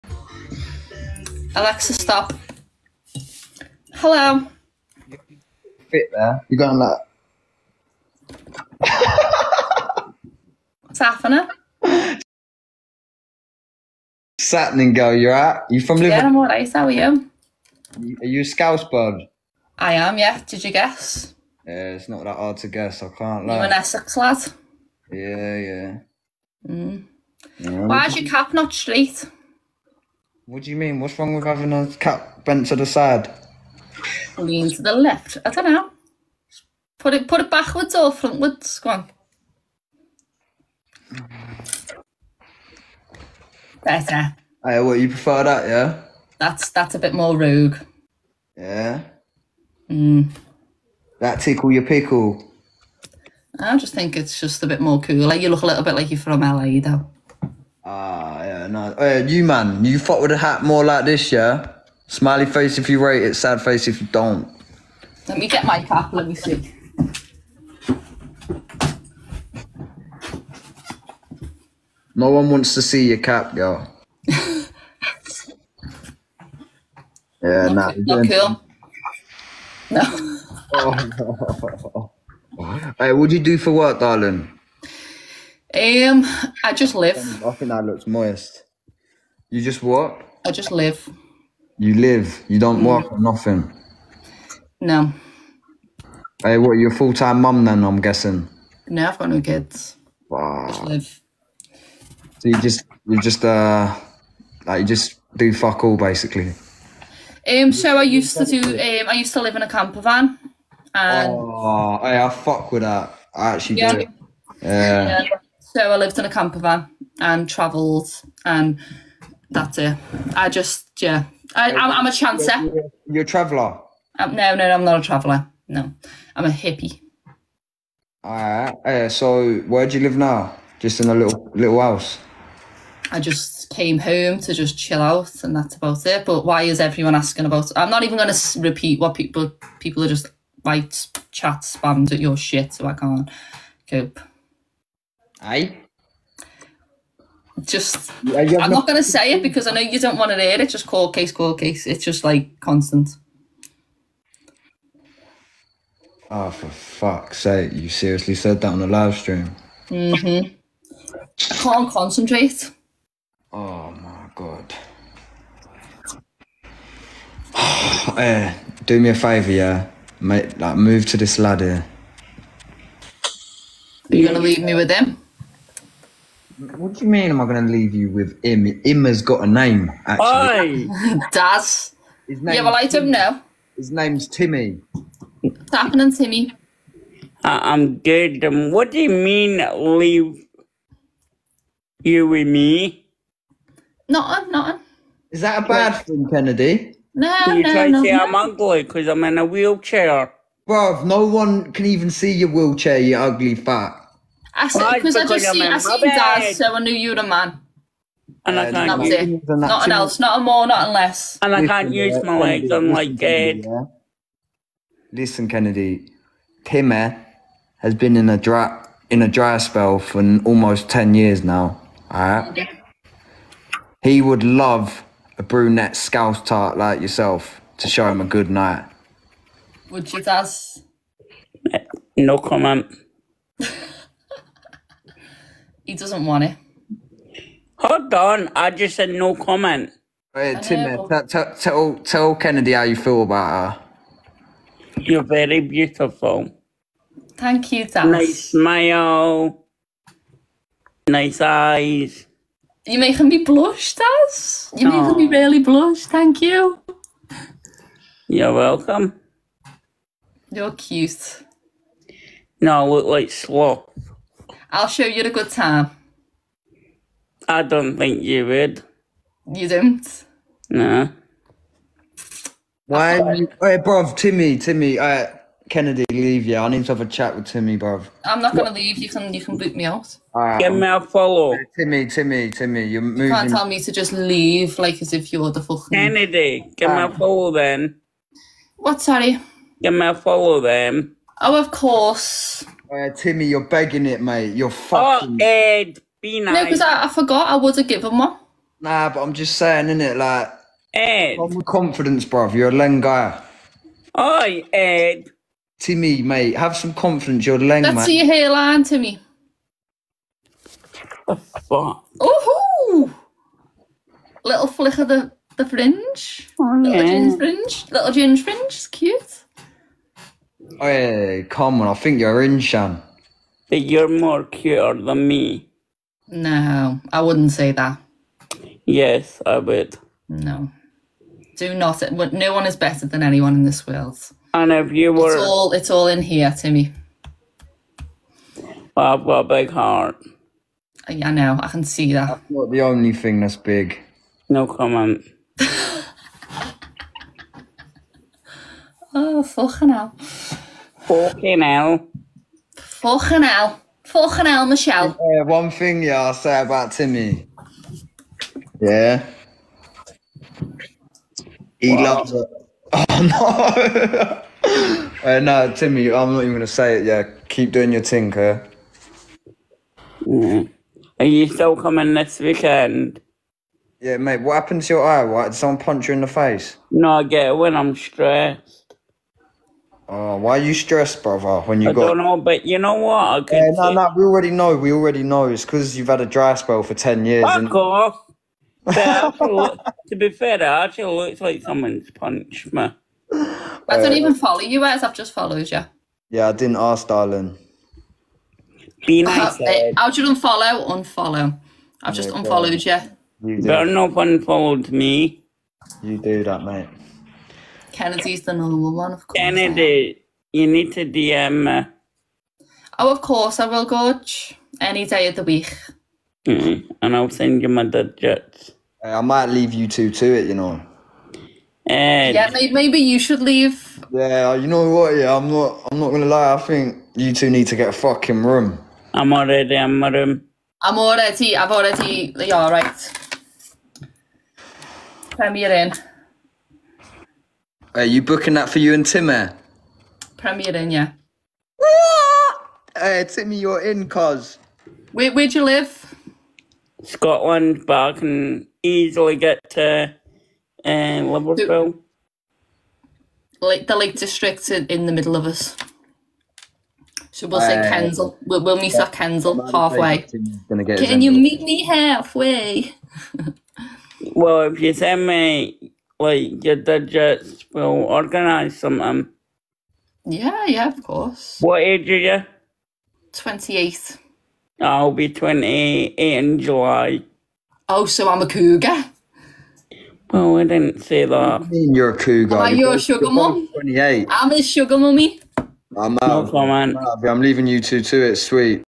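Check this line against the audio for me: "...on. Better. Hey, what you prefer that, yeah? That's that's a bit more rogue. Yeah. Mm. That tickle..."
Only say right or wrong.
right.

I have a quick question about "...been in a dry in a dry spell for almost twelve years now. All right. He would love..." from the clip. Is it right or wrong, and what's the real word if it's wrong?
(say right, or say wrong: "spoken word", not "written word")
wrong: "ten", not "twelve".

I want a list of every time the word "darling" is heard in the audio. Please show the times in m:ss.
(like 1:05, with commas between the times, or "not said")
1:23, 6:37.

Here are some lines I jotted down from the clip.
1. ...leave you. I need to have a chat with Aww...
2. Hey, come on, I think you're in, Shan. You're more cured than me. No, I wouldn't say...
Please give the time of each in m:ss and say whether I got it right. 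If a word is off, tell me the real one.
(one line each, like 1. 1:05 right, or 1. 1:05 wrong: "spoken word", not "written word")
1. 4:36 wrong: "Timmy", not "Aww"
2. 5:20 right.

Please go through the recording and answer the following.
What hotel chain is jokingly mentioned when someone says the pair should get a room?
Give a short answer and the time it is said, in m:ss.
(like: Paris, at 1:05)
Premier Inn, at 7:15.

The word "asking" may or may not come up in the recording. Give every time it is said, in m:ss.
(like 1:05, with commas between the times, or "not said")
2:17.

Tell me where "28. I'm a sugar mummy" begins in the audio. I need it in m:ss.
8:03.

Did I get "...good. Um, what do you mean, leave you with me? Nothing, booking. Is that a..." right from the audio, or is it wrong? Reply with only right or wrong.
wrong.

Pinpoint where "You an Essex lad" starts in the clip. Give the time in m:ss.
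0:23.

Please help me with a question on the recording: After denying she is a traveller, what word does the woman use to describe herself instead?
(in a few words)
hippie.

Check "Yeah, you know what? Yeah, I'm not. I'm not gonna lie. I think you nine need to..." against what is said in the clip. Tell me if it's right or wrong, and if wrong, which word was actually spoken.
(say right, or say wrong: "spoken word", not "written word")
wrong: "two", not "nine".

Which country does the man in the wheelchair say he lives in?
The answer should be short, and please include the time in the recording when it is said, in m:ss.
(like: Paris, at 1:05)
Scotland, at 7:27.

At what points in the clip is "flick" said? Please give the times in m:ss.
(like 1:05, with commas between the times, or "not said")
5:14.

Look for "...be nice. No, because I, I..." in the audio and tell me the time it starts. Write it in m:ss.
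4:56.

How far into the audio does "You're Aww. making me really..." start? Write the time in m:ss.
4:14.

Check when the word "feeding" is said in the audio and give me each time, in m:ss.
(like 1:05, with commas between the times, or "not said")
not said.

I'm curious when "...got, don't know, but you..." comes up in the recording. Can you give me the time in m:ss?
6:21.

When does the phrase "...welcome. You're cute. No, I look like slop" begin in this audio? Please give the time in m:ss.
4:18.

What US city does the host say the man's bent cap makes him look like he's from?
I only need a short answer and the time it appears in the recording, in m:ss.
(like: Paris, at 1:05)
LA, at 0:56.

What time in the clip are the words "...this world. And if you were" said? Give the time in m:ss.
5:33.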